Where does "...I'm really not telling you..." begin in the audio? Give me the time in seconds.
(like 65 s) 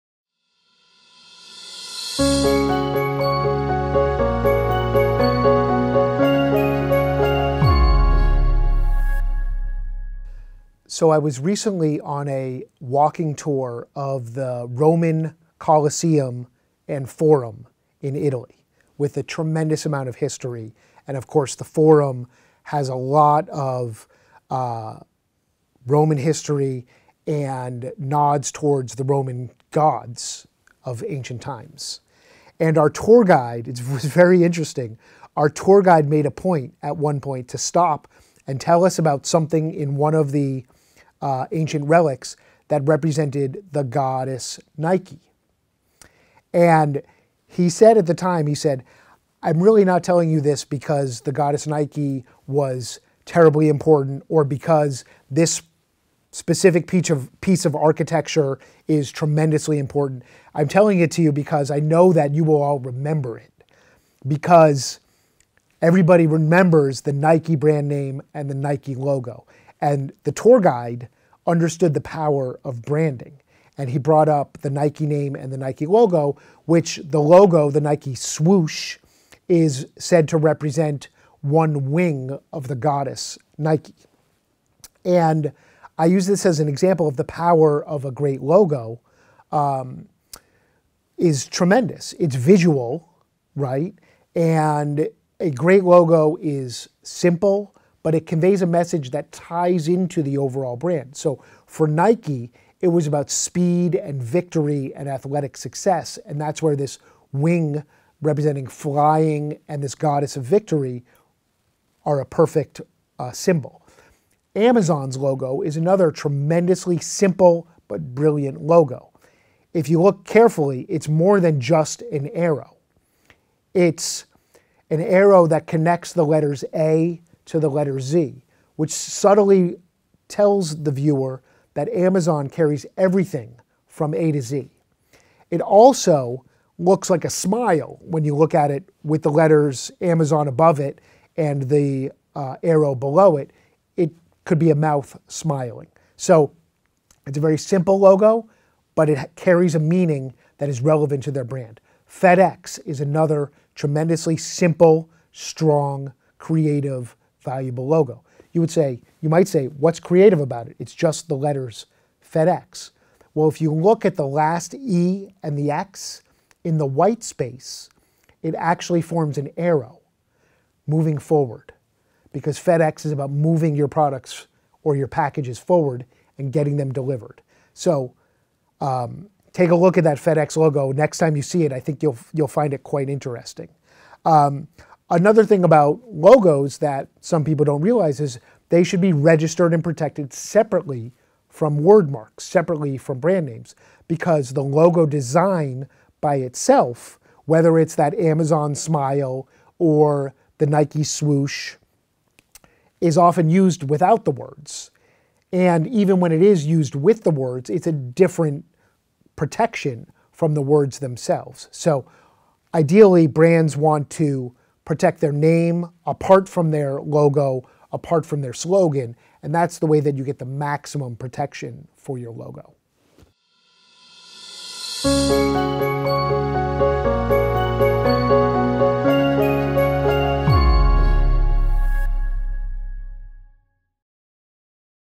49 s.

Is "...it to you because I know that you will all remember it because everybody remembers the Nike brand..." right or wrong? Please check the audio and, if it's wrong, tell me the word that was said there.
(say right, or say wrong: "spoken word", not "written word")
right.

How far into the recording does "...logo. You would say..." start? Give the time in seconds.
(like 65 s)
157 s.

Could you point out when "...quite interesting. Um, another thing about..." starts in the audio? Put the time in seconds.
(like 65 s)
182 s.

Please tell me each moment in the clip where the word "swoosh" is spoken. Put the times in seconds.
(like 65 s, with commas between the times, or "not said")
78 s, 201 s.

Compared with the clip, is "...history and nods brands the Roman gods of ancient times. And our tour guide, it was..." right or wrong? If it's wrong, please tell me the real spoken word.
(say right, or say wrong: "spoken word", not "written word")
wrong: "towards", not "brands".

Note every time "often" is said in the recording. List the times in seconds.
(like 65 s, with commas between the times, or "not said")
203 s.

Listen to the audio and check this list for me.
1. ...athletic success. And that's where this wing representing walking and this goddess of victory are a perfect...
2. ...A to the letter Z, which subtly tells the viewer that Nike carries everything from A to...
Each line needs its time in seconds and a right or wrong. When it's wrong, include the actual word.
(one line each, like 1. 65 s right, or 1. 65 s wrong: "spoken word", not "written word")
1. 105 s wrong: "flying", not "walking"
2. 126 s wrong: "Amazon", not "Nike".